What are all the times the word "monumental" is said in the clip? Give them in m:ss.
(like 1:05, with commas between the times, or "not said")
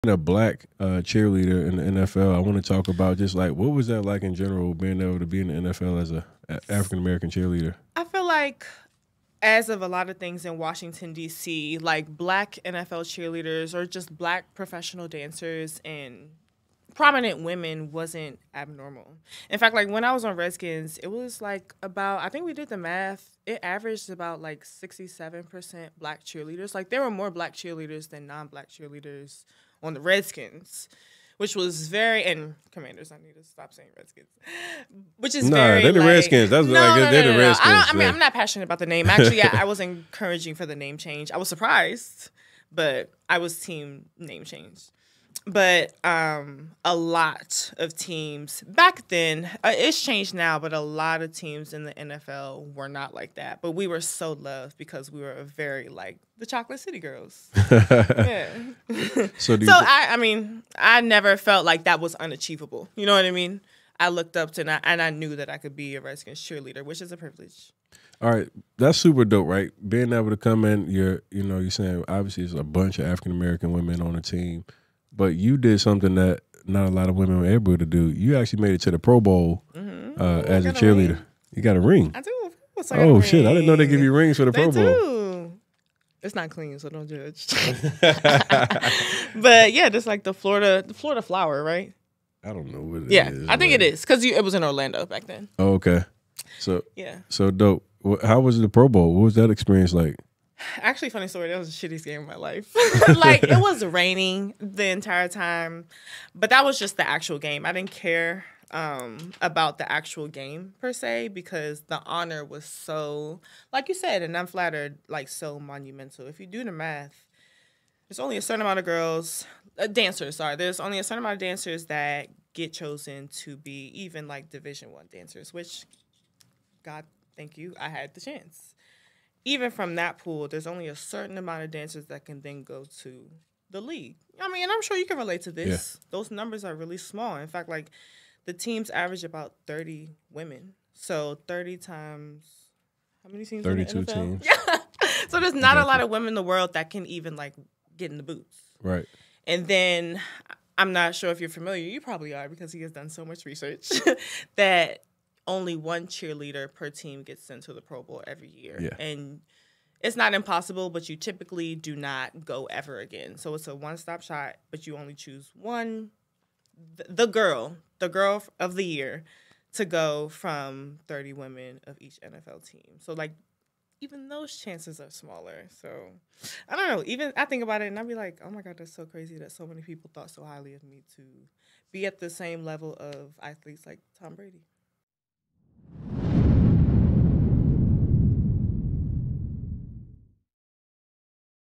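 1:55.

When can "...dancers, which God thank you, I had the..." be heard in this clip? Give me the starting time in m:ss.
2:05.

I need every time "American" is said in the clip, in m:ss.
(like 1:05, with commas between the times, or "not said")
0:06, 1:13.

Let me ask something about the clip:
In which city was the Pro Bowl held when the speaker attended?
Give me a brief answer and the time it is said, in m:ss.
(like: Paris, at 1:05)
Orlando, at 1:34.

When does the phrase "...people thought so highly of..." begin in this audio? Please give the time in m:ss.
2:59.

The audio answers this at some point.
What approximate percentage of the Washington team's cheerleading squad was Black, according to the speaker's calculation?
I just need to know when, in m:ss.
0:24.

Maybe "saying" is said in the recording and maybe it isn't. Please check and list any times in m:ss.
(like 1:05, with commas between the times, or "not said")
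0:33, 1:11.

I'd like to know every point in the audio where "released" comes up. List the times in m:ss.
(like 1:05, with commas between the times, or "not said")
not said.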